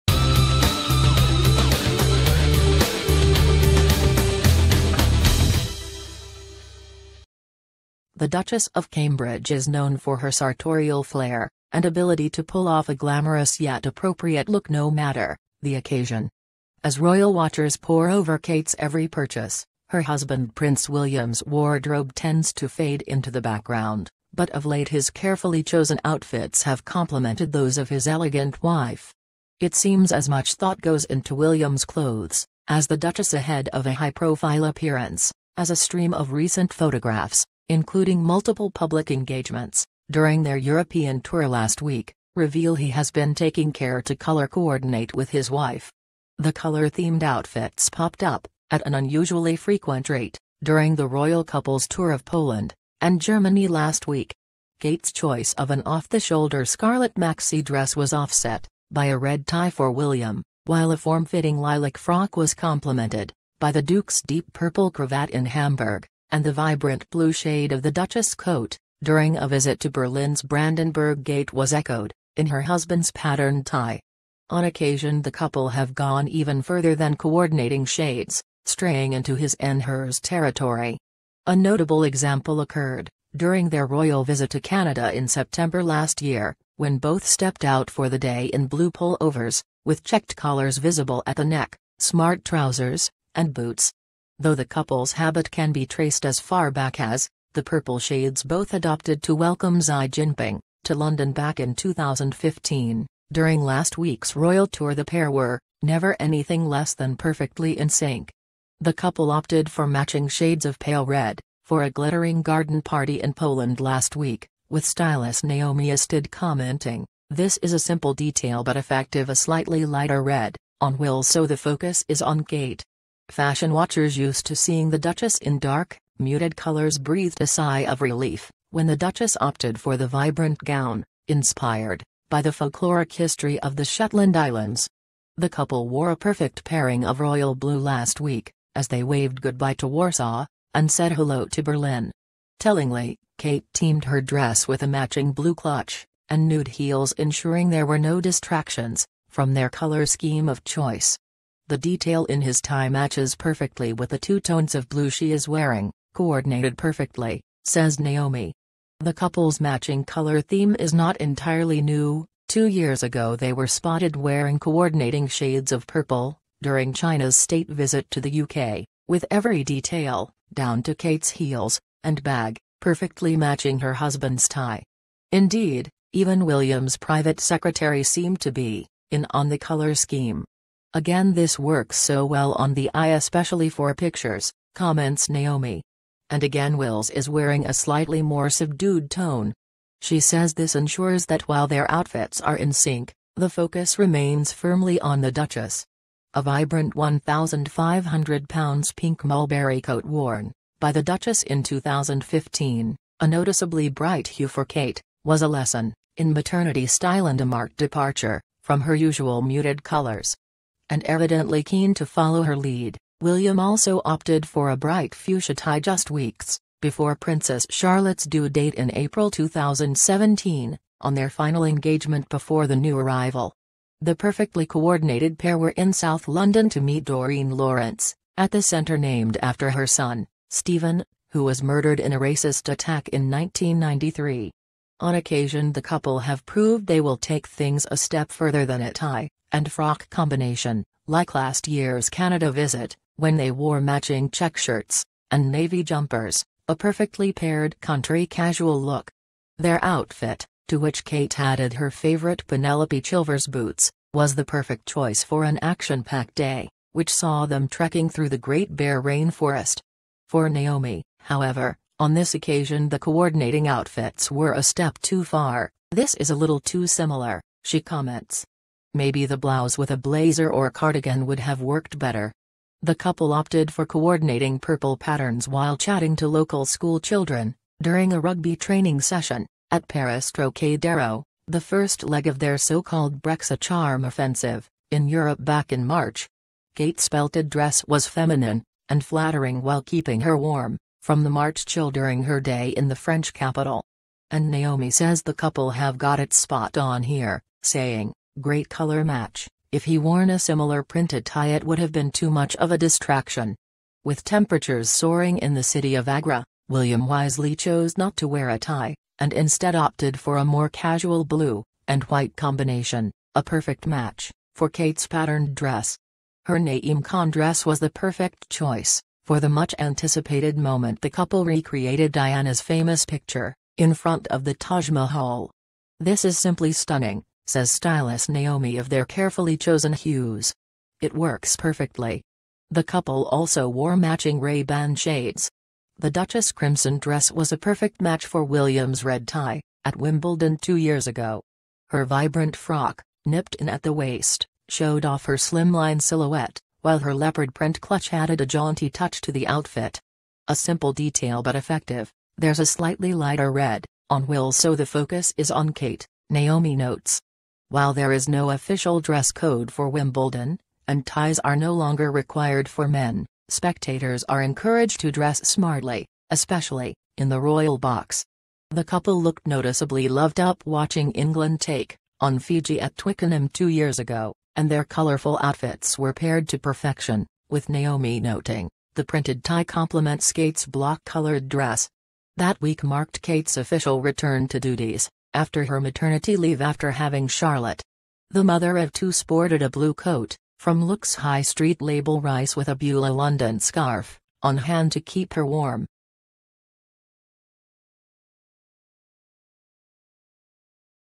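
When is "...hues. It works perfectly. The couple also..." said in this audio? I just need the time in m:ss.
5:29.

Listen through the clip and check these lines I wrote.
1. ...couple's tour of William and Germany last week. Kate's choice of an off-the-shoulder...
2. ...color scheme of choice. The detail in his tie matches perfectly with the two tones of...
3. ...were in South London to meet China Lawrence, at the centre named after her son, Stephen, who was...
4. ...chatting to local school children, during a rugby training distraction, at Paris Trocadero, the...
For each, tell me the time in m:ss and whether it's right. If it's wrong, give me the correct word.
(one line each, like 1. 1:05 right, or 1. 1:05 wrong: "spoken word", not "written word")
1. 0:51 wrong: "Poland", not "William"
2. 2:29 right
3. 3:45 wrong: "Doreen", not "China"
4. 4:35 wrong: "session", not "distraction".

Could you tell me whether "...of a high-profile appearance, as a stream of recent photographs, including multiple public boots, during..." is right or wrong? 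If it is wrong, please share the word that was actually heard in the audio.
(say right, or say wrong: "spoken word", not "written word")
wrong: "engagements", not "boots".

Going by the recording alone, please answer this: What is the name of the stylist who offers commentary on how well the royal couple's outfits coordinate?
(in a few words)
Naomi Isted.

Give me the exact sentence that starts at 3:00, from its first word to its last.
Again this works so well on the eye especially for pictures, comments Naomi.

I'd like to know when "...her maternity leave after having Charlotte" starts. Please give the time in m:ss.
6:25.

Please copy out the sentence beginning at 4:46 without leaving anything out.
Kate's belted dress was feminine, and flattering while keeping her warm from the March chill during her day in the French capital.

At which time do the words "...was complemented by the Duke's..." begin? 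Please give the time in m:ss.
1:02.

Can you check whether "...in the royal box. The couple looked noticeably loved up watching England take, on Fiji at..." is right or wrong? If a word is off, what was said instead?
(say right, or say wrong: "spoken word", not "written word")
right.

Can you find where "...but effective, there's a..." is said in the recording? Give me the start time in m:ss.
5:51.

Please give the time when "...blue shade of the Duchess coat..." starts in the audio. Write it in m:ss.
1:07.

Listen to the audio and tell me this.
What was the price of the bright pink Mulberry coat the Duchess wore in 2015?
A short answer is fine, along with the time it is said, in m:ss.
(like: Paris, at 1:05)
1,500 pounds, at 3:16.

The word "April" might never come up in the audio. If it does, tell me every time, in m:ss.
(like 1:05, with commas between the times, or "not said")
3:38.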